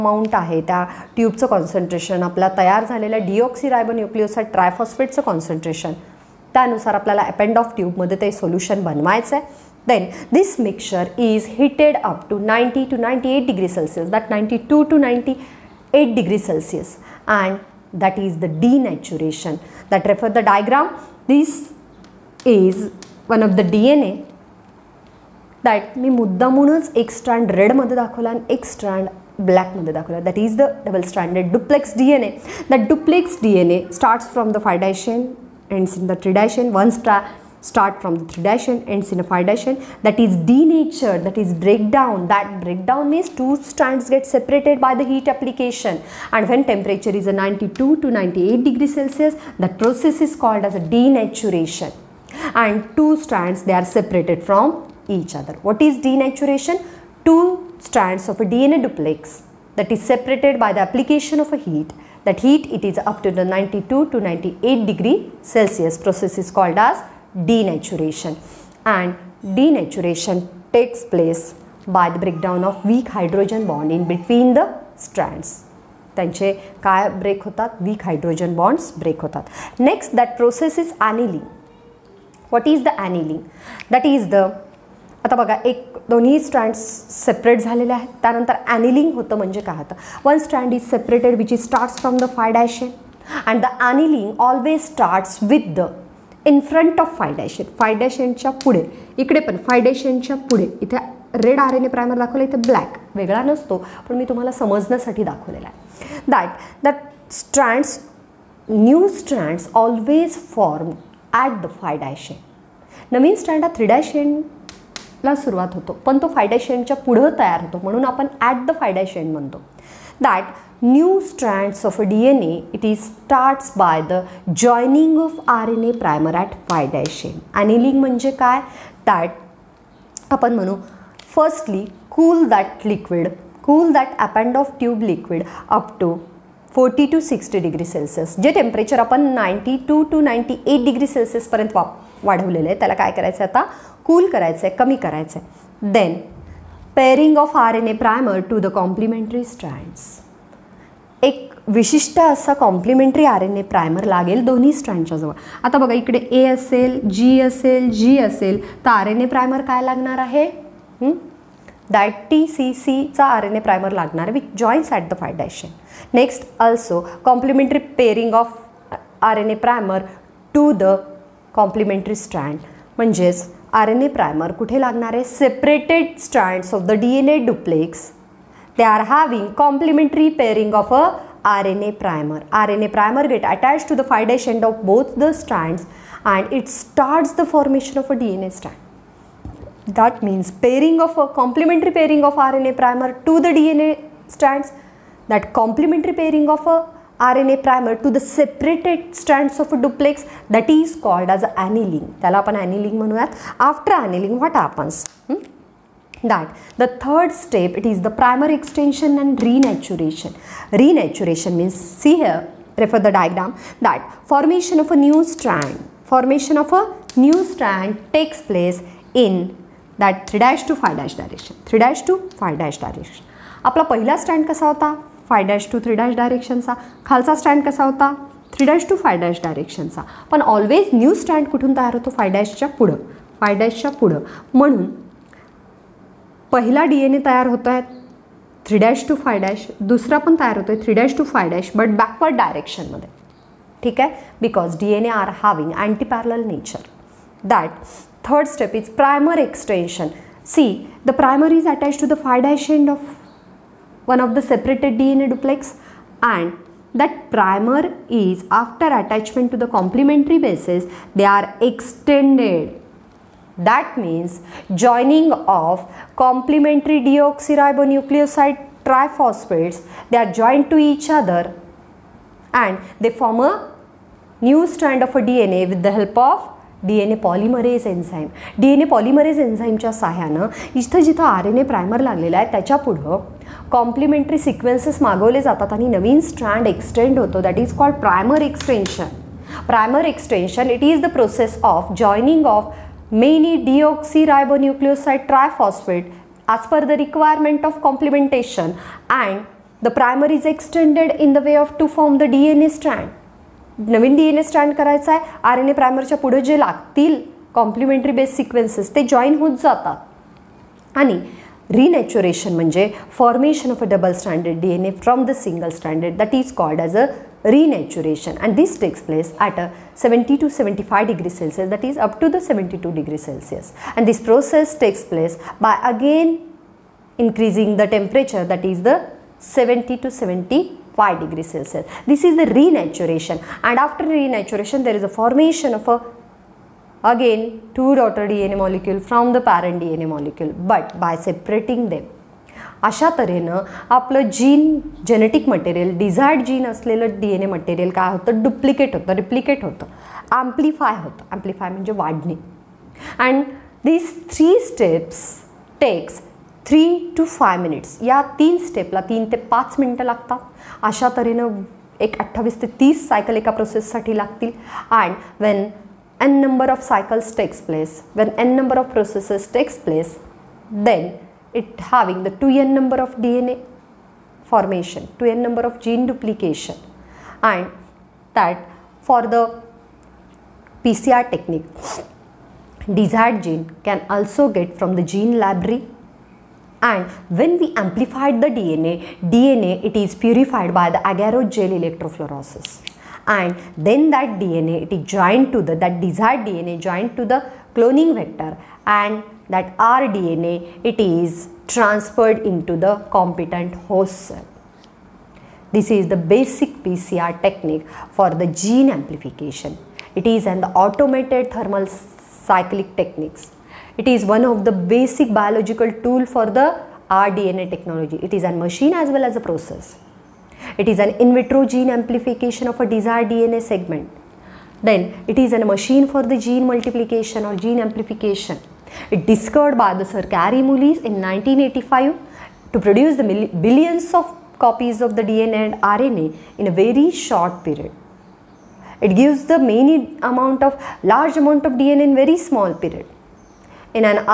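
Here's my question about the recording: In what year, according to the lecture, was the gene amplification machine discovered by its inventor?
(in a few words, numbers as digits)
1985.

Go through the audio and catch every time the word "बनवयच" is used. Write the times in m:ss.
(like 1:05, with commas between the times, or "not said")
0:08.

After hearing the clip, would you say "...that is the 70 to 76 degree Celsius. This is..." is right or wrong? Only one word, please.
wrong.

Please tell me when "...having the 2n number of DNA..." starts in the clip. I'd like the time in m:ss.
6:11.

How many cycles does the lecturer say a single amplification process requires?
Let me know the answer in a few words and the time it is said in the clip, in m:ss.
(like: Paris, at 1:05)
28 to 30, at 6:02.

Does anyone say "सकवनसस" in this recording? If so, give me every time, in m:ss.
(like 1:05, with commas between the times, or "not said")
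4:44, 5:08.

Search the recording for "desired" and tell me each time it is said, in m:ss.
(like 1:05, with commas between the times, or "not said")
6:22, 6:36, 7:02.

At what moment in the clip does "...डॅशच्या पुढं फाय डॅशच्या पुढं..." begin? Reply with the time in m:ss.
3:52.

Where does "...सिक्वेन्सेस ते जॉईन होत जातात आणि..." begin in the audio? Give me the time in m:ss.
5:08.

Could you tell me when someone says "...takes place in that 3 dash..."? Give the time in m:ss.
3:38.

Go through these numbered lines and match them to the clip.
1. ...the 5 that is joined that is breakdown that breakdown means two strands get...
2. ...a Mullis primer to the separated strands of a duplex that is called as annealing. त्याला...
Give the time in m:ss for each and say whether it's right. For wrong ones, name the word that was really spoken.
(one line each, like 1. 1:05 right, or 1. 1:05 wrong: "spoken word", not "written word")
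1. 0:39 wrong: "denatured", not "joined"
2. 3:16 wrong: "RNA", not "Mullis".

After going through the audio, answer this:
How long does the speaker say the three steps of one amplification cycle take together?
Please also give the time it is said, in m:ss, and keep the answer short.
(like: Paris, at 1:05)
3 to 5 minutes, at 5:56.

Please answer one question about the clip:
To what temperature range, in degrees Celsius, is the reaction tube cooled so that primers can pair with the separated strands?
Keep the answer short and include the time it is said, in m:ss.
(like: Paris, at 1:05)
42 to 60 degrees Celsius, at 2:16.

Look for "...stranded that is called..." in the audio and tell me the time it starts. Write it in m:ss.
5:15.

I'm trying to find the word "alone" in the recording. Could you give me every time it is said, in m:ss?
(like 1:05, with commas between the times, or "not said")
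not said.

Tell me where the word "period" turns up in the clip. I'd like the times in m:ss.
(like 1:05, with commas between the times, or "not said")
7:17, 7:22.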